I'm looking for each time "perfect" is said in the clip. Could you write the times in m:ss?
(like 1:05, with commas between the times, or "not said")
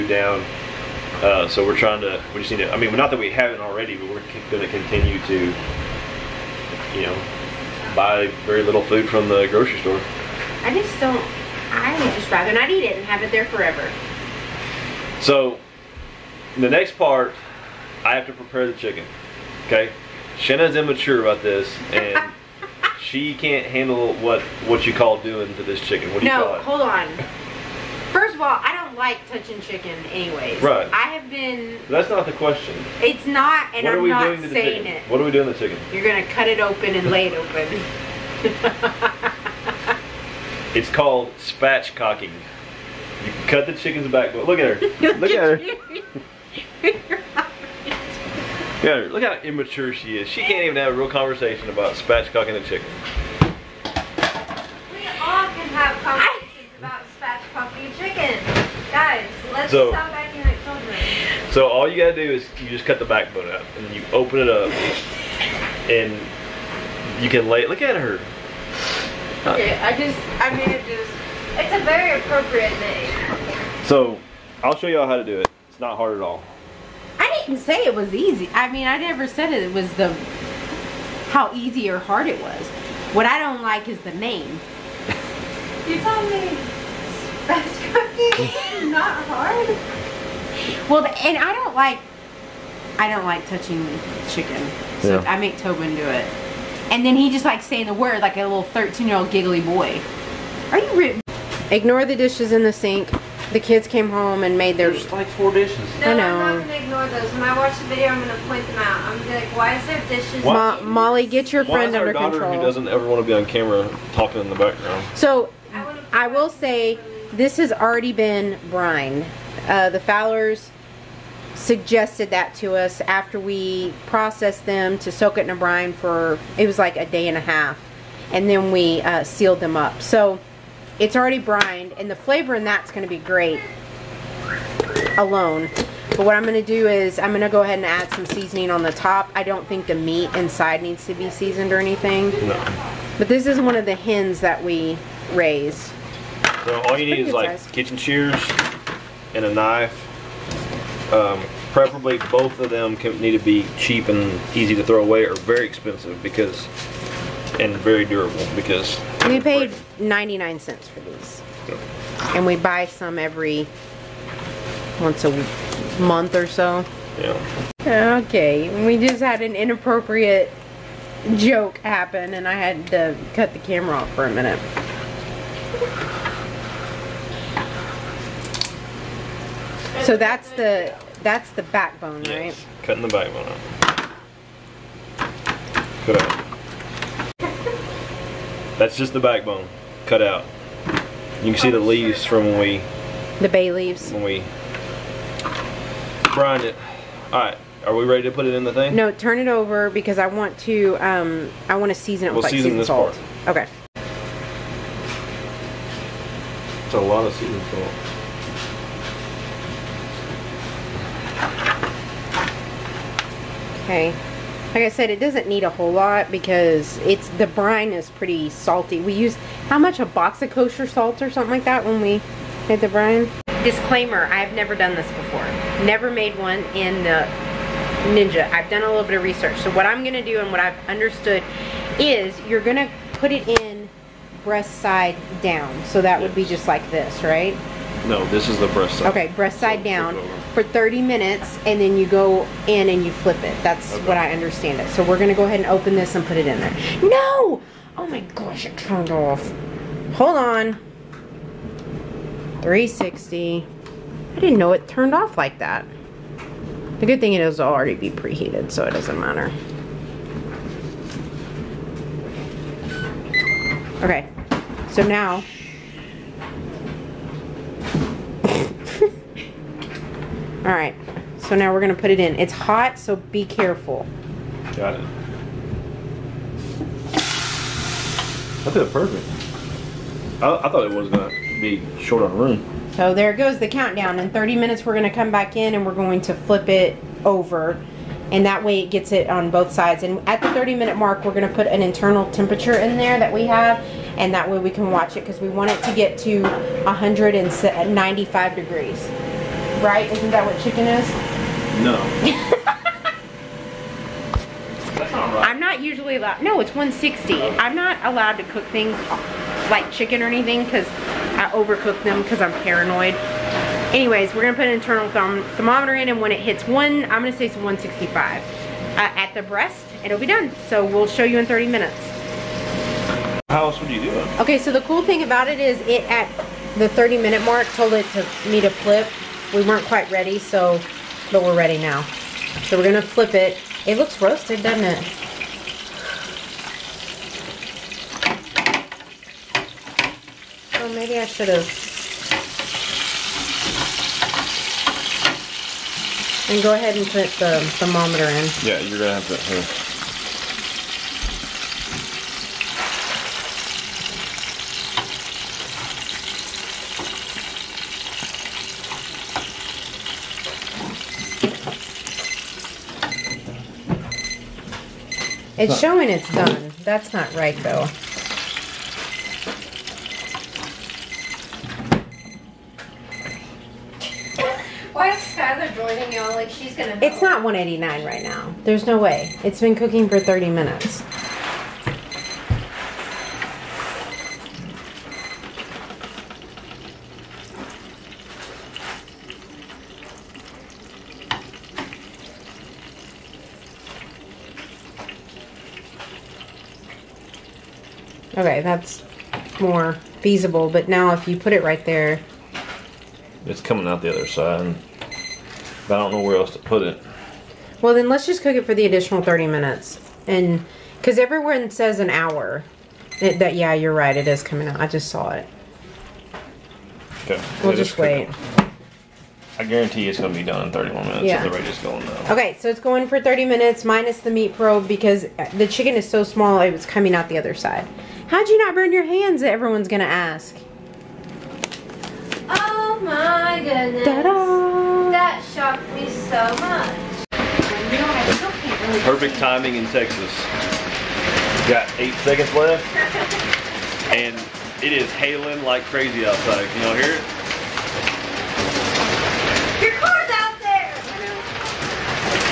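4:38, 7:19.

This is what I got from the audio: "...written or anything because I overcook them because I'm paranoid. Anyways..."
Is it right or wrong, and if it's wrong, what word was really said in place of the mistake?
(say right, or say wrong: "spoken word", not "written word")
wrong: "chicken", not "written".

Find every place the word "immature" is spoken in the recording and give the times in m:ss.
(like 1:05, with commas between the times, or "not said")
0:20, 0:49.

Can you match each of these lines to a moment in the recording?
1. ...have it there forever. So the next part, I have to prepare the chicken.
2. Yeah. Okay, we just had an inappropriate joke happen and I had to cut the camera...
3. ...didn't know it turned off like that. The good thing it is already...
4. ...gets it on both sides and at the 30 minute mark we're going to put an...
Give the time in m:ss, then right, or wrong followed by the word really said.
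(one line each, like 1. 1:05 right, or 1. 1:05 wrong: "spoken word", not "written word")
1. 0:13 right
2. 2:47 right
3. 4:14 right
4. 4:48 right.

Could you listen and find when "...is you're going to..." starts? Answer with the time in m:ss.
3:51.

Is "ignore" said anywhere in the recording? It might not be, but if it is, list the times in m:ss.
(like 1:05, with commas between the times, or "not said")
1:41, 1:46.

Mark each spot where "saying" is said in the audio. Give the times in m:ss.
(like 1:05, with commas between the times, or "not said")
0:34, 1:37.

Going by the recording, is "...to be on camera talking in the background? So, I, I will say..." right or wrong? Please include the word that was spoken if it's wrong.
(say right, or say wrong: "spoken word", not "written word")
right.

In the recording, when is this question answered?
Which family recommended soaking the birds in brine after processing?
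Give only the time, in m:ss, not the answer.
1:59.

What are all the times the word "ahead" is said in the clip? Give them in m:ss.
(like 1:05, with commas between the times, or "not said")
2:17, 4:05, 5:46.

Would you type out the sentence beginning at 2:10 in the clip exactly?
So it's already brined, and the flavor in that's going to be great alone.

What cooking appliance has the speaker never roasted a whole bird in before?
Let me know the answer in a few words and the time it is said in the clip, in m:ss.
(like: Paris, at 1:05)
Ninja, at 3:45.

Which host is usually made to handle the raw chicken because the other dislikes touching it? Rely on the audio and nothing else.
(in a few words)
Tobin.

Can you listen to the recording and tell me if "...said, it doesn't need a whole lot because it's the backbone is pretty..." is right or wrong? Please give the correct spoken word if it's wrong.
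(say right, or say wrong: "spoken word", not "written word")
wrong: "brine", not "backbone".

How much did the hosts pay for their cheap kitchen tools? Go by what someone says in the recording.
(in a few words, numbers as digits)
99 cents.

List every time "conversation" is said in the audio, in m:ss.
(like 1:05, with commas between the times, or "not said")
0:51, 0:56.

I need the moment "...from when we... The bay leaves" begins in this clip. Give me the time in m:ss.
3:12.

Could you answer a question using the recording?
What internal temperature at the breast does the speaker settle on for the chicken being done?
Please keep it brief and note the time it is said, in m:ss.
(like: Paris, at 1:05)
165 degrees, at 5:17.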